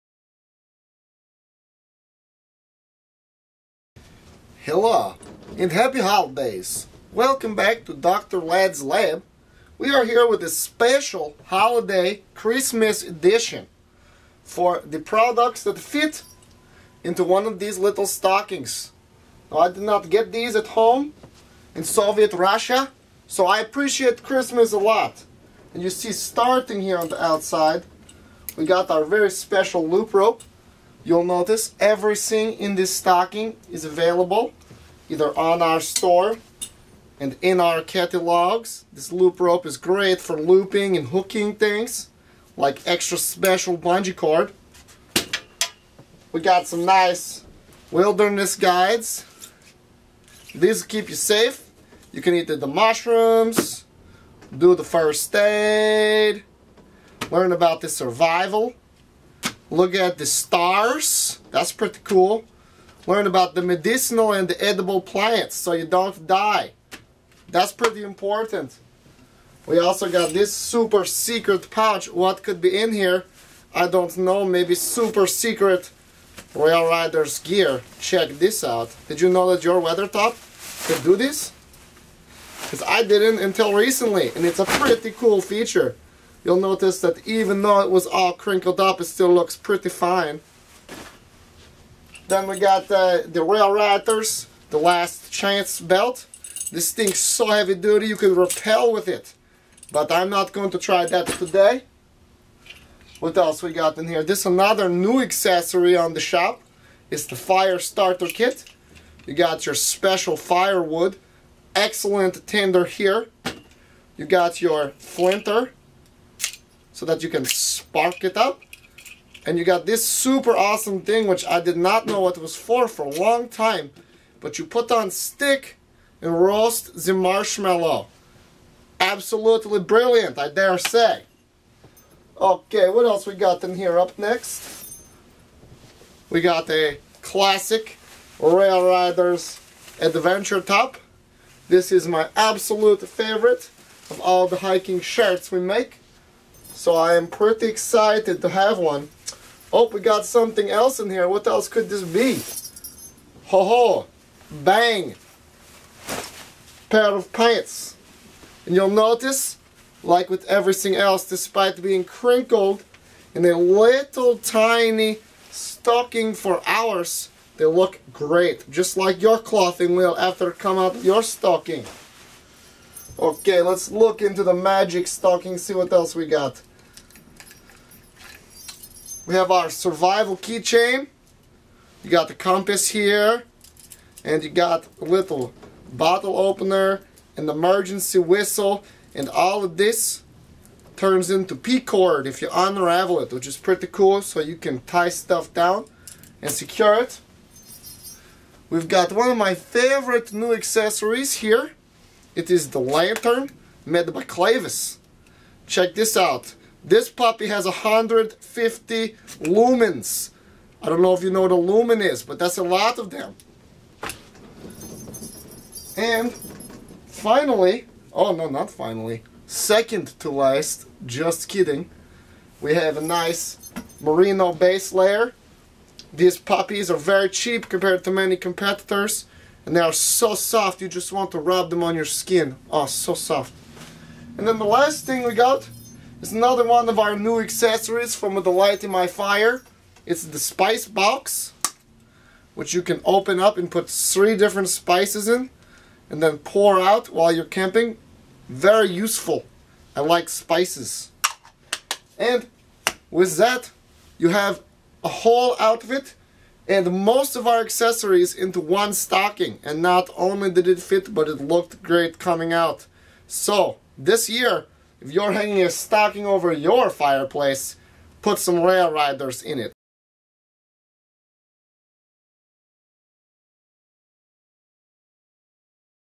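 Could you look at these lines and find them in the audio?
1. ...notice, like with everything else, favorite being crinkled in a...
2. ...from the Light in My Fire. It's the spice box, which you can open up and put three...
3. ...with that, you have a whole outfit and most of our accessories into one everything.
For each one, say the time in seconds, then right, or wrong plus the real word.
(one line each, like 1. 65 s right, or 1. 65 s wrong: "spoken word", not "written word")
1. 158 s wrong: "despite", not "favorite"
2. 238 s right
3. 253 s wrong: "stocking", not "everything".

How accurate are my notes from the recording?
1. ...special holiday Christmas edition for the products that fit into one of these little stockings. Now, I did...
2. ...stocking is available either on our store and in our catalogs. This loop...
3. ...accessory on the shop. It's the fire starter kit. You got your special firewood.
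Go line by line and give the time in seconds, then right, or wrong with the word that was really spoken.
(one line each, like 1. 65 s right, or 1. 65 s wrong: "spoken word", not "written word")
1. 10 s right
2. 32 s right
3. 105 s right.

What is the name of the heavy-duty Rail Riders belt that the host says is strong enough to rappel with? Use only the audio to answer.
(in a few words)
Last Chance.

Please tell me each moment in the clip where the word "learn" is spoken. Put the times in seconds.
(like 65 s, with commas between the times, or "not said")
57 s, 63 s.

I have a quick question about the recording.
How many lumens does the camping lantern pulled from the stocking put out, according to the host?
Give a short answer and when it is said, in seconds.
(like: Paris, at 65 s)
150, at 207 s.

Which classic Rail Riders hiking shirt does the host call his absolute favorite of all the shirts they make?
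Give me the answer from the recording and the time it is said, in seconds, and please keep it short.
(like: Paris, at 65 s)
Adventure Top, at 139 s.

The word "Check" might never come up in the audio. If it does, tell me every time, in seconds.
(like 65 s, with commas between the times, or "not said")
77 s, 205 s.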